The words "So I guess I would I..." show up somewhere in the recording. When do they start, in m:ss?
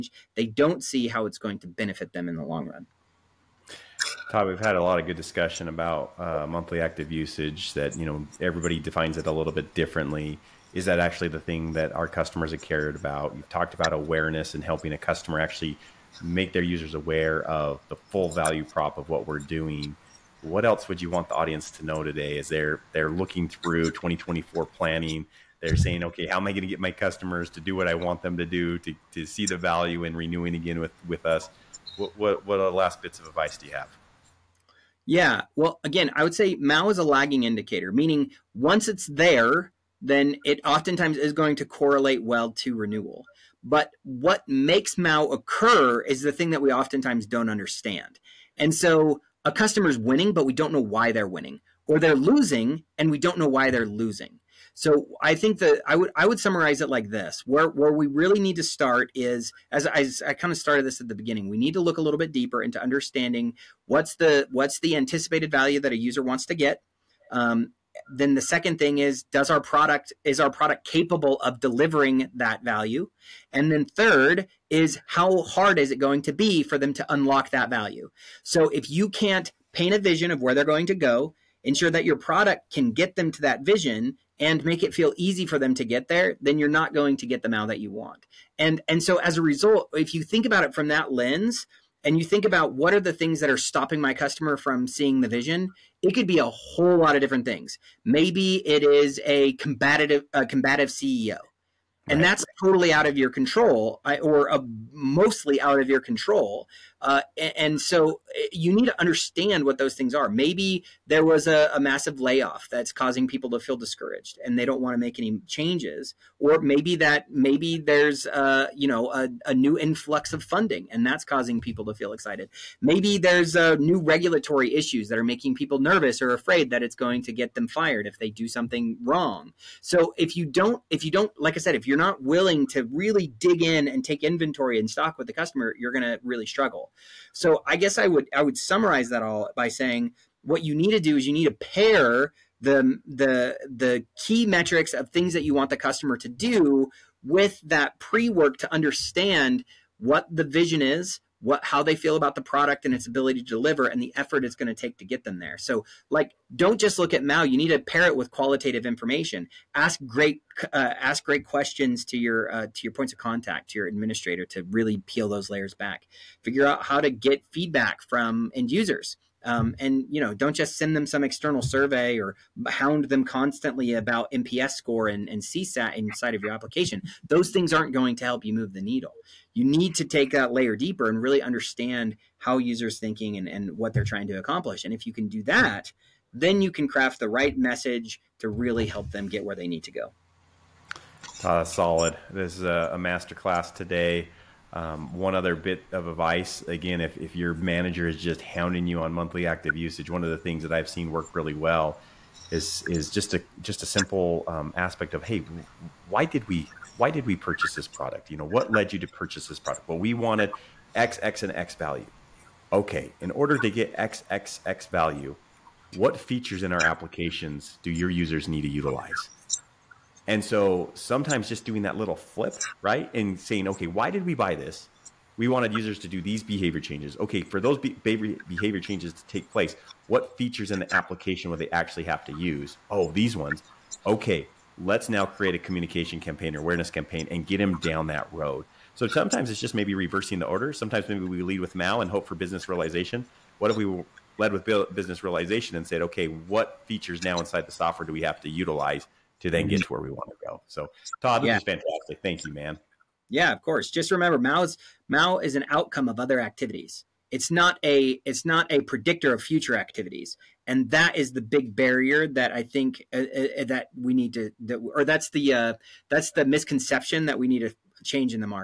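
2:17.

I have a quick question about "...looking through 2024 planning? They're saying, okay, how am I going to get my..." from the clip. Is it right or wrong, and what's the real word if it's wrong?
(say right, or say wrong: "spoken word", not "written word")
right.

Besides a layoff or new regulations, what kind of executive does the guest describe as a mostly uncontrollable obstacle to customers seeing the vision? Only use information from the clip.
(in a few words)
combative CEO.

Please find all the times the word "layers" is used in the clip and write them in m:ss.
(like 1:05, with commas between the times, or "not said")
2:45, 3:00.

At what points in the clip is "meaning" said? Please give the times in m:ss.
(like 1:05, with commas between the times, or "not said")
0:37.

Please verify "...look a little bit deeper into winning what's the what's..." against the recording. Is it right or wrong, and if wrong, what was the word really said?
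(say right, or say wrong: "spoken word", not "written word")
wrong: "understanding", not "winning".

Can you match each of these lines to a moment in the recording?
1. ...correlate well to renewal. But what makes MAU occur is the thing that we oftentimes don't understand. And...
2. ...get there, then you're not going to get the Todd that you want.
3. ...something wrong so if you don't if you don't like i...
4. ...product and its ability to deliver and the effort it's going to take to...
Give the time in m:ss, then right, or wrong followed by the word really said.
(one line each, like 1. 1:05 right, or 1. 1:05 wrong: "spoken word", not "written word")
1. 0:41 right
2. 1:25 wrong: "MAU", not "Todd"
3. 2:08 right
4. 2:32 right.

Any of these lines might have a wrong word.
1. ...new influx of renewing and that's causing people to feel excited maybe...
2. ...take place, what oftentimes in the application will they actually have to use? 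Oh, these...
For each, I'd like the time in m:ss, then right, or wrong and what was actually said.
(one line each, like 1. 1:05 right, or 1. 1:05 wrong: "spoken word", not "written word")
1. 1:59 wrong: "funding", not "renewing"
2. 3:49 wrong: "features", not "oftentimes".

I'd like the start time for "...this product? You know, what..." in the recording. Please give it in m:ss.
3:27.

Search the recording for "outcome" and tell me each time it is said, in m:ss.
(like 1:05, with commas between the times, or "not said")
4:15.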